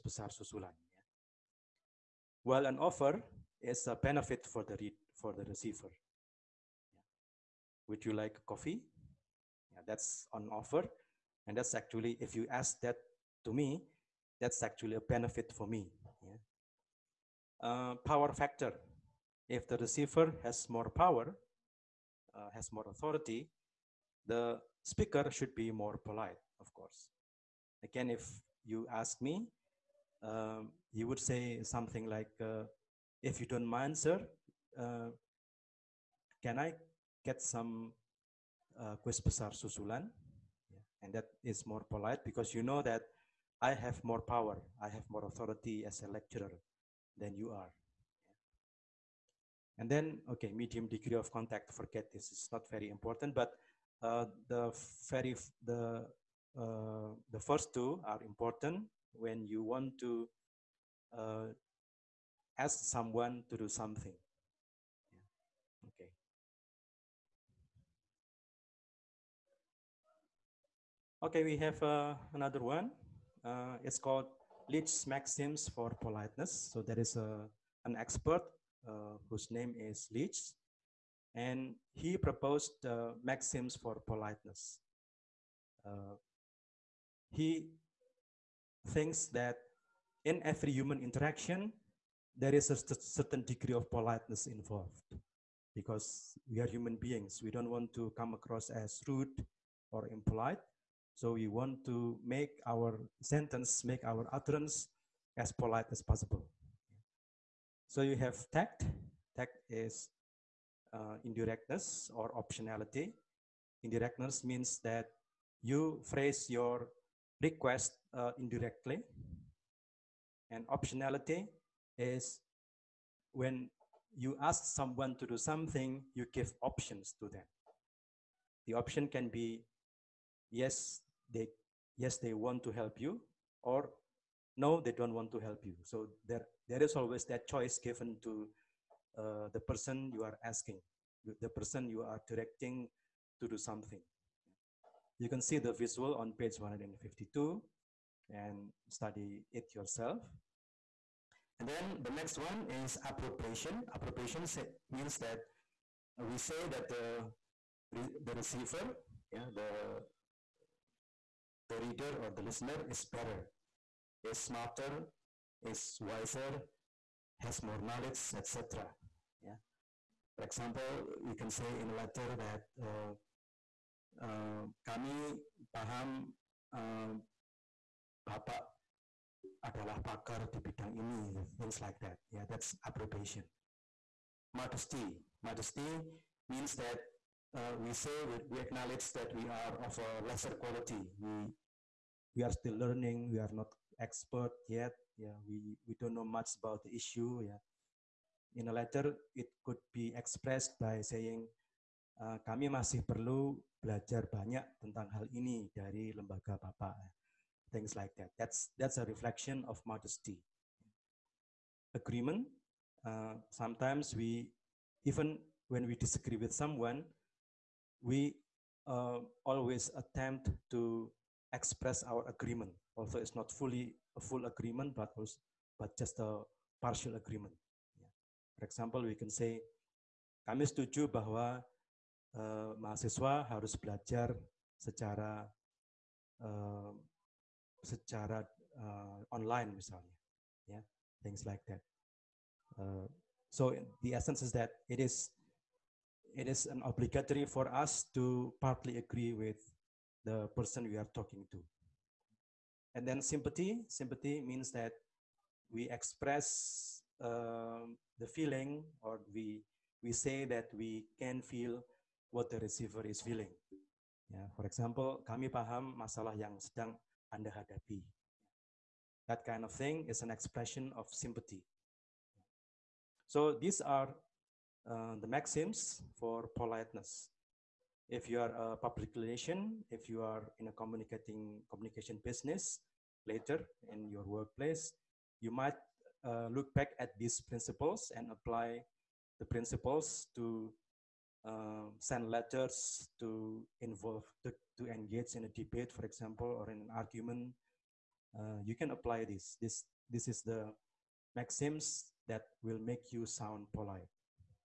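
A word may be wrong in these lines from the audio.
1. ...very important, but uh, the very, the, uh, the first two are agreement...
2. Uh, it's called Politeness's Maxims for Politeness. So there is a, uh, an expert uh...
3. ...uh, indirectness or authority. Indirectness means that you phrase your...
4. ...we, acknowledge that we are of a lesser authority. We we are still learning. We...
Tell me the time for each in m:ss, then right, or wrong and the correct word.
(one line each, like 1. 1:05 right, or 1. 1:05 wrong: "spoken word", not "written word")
1. 0:52 wrong: "important", not "agreement"
2. 1:13 wrong: "Leech", not "Politeness"
3. 1:50 wrong: "optionality", not "authority"
4. 3:08 wrong: "quality", not "authority".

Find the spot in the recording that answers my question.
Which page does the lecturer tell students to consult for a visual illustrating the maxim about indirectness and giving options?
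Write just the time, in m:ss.
2:26.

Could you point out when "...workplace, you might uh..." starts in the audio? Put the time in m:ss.
4:44.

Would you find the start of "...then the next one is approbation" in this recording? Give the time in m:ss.
2:31.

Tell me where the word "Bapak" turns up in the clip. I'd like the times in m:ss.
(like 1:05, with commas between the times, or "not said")
2:58, 3:26.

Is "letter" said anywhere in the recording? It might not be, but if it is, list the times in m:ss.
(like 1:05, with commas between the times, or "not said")
2:51, 3:18, 4:52.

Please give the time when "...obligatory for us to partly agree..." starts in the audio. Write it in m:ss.
4:06.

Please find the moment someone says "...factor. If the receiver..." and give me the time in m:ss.
0:18.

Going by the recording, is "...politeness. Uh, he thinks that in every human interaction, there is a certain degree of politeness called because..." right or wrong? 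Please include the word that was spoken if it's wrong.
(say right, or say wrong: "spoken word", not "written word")
wrong: "involved", not "called".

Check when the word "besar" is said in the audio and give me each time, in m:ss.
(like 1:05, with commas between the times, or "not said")
0:00, 0:39.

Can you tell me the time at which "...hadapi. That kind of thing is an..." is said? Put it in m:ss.
4:27.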